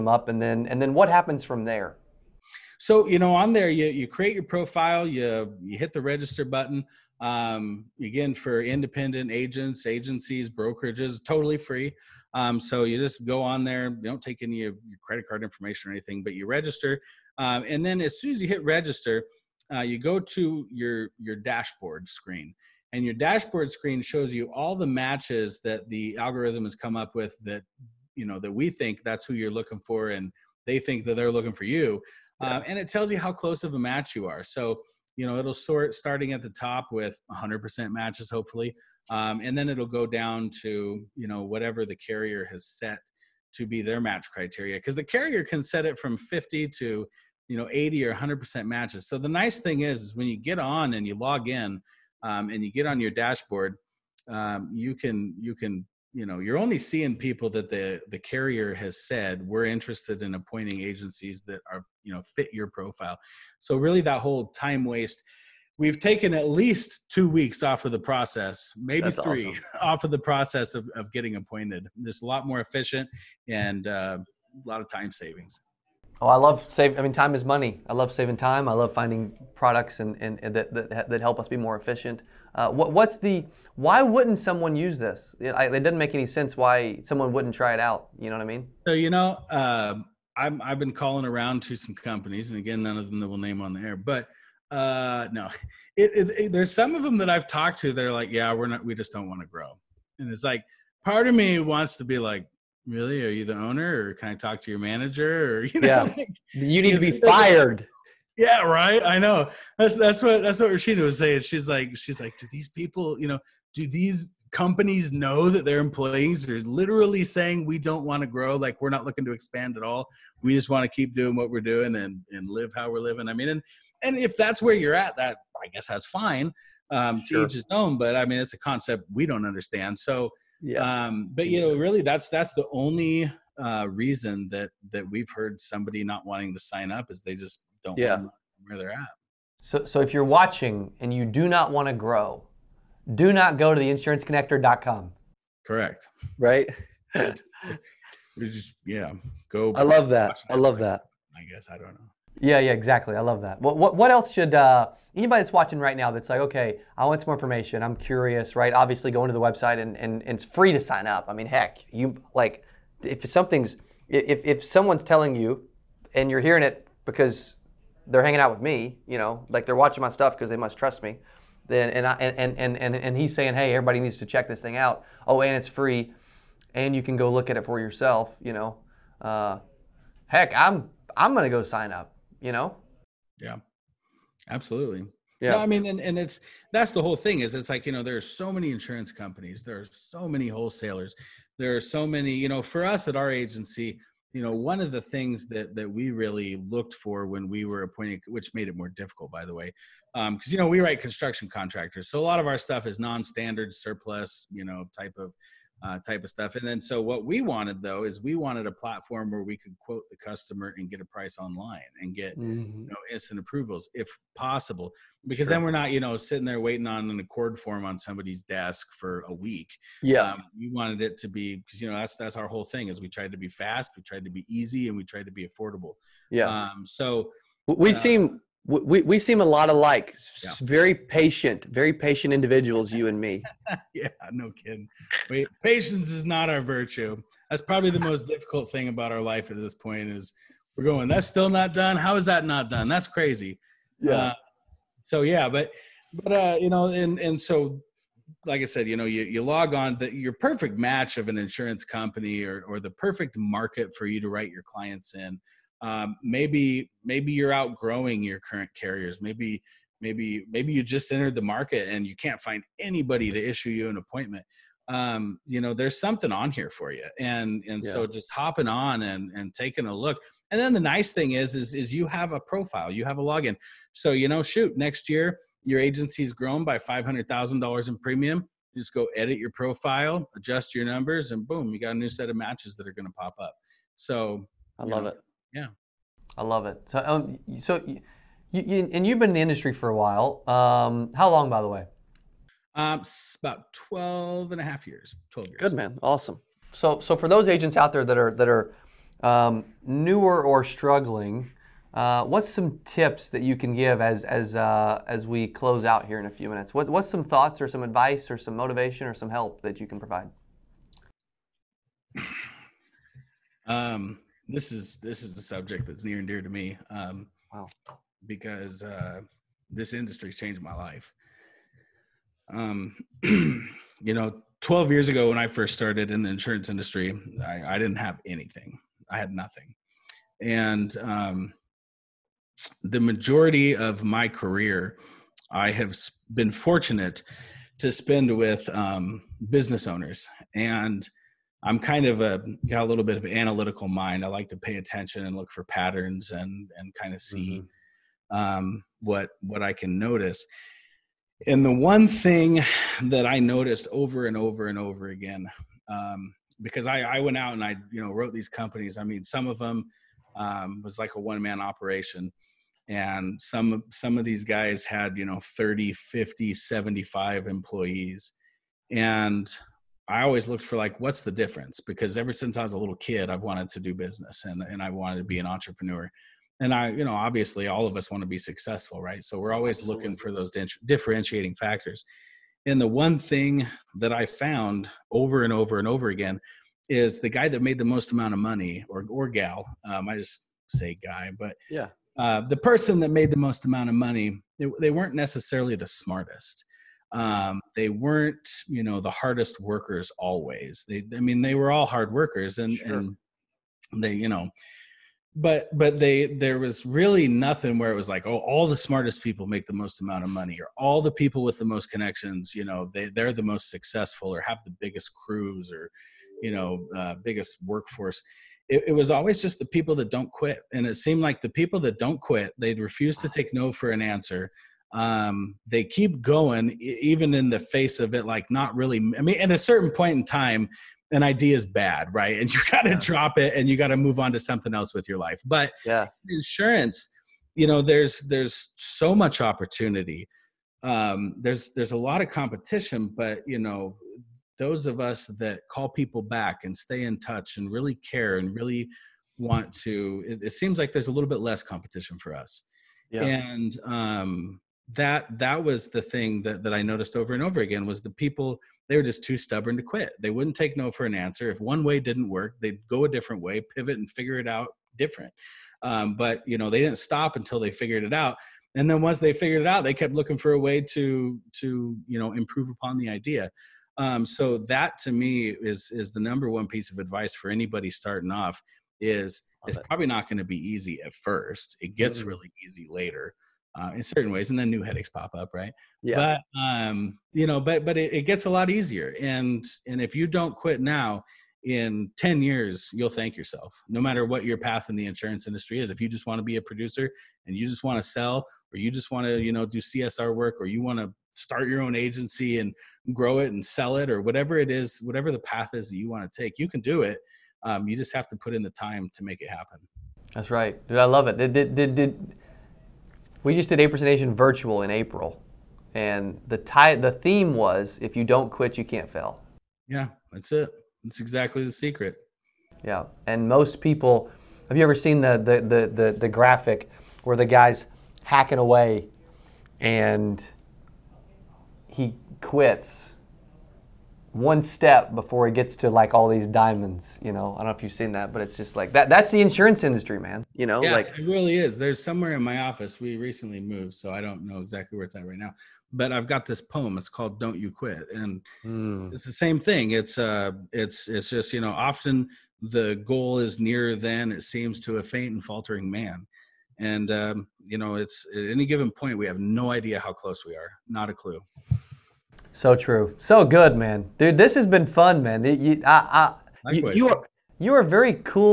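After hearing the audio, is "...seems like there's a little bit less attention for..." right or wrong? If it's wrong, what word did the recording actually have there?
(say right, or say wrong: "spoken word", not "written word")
wrong: "competition", not "attention".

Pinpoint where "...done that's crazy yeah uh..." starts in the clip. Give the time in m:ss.
4:02.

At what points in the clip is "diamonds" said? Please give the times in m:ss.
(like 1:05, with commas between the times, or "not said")
8:56.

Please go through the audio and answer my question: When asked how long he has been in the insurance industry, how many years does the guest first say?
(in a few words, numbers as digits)
12 and a half.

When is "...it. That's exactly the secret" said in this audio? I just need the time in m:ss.
8:40.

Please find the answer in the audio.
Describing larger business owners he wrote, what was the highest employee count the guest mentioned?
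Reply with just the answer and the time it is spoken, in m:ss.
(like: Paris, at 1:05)
75, at 6:06.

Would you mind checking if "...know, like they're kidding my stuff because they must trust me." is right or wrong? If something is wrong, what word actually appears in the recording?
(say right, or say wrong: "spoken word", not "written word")
wrong: "watching", not "kidding".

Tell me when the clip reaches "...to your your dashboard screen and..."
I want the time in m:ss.
0:20.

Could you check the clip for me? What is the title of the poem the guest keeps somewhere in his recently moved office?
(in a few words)
Don't You Quit.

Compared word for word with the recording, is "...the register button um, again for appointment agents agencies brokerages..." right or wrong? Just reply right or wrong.
wrong.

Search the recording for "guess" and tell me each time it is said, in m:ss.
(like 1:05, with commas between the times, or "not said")
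2:05, 2:31.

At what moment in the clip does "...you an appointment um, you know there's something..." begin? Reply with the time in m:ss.
4:23.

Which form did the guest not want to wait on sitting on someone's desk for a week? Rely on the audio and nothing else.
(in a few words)
ACORD form.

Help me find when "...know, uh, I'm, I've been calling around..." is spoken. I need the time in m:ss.
1:29.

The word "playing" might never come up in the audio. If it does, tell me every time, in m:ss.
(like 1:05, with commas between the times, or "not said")
not said.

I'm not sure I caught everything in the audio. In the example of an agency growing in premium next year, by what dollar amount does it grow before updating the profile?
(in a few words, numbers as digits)
$500,000.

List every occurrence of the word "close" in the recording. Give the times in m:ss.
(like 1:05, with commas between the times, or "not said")
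0:33, 5:05, 9:20.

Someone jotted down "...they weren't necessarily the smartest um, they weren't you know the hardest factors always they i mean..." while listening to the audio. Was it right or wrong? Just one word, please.
wrong.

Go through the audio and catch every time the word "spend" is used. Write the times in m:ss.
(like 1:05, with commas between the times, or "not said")
5:37.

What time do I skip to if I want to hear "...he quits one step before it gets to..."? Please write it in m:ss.
8:51.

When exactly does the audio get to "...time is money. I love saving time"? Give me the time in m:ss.
1:17.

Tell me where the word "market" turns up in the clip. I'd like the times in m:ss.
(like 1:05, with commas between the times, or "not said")
4:13, 4:21.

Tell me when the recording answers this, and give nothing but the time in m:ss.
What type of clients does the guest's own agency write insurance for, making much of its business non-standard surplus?
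3:20.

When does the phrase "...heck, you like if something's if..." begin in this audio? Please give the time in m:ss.
2:41.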